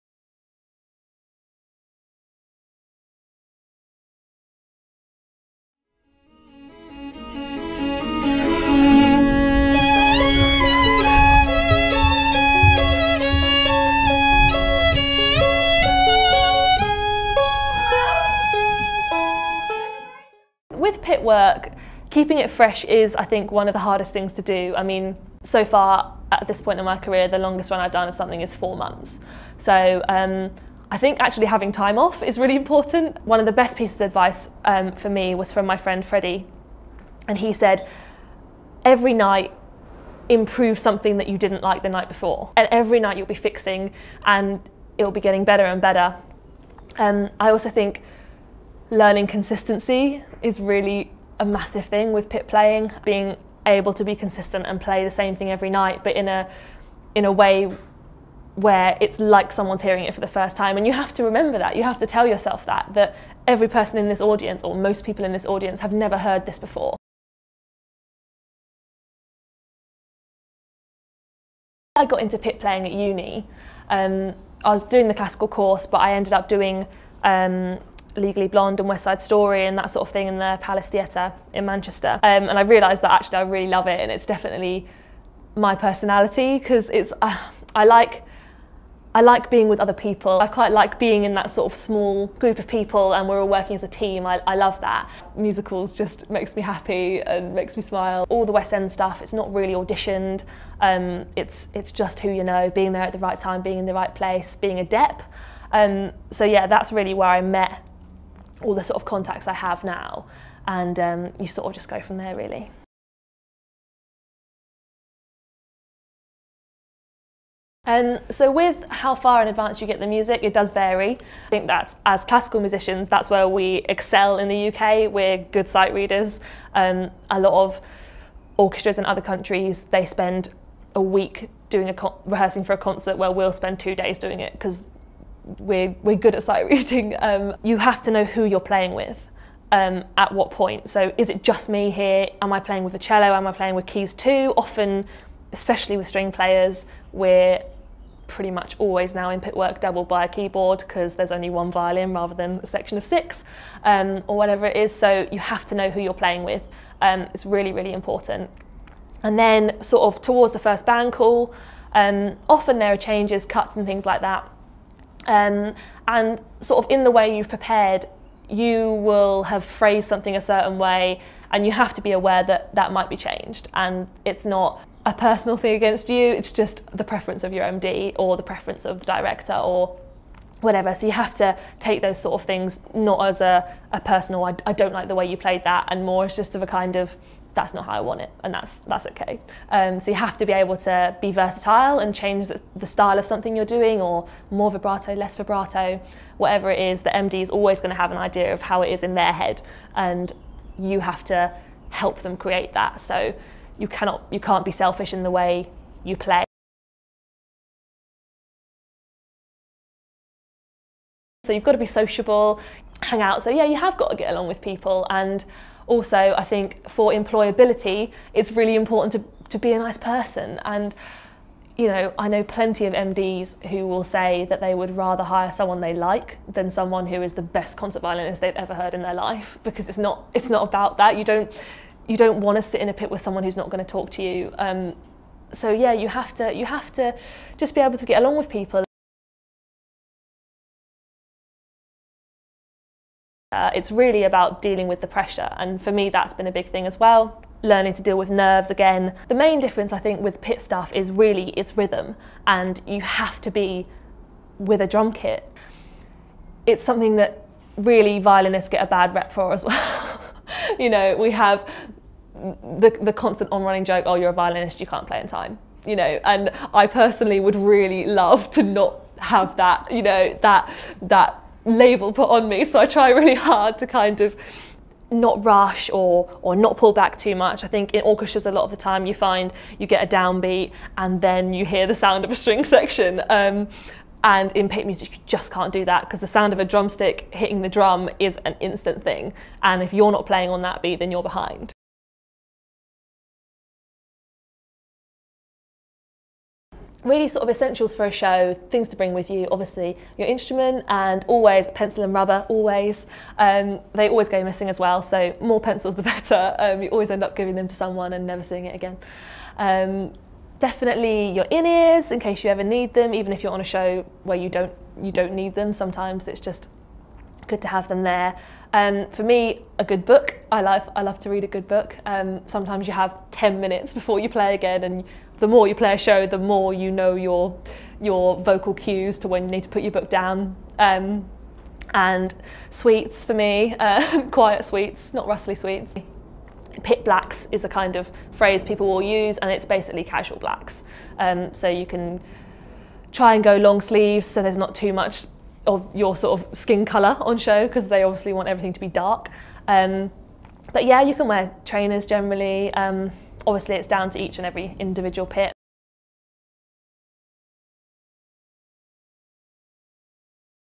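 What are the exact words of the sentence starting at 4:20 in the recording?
you know, we have the, the constant on running joke oh, you're a violinist, you can't play in time.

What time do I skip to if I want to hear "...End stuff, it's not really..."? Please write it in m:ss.
1:38.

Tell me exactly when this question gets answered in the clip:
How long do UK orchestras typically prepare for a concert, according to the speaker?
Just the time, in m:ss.
2:13.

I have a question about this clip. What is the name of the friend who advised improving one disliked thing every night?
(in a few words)
Freddie.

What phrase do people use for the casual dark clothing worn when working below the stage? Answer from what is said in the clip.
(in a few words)
Pit blacks.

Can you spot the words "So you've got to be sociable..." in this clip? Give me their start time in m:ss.
3:31.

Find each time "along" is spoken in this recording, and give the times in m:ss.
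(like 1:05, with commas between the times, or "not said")
3:34, 3:58.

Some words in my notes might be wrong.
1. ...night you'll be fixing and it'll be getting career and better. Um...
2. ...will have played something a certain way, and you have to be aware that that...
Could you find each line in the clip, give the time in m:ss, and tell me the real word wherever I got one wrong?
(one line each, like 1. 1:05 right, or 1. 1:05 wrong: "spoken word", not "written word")
1. 0:42 wrong: "better", not "career"
2. 2:48 wrong: "phrased", not "played".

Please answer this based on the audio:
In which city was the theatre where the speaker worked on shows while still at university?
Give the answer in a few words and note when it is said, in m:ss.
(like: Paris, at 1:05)
Manchester, at 1:21.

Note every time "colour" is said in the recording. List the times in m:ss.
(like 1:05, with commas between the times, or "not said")
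5:46.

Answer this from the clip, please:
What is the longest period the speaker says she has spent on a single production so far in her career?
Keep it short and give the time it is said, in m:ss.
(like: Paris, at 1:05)
4 months, at 0:28.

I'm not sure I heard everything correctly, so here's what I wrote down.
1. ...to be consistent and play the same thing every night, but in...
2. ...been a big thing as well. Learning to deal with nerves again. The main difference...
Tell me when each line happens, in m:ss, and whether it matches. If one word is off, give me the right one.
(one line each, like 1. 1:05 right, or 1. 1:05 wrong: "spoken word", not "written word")
1. 0:53 right
2. 4:06 right.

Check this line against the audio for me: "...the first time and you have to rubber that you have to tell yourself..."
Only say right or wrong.
wrong.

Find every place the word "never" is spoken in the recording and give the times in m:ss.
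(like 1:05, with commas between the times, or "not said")
1:05, 5:08.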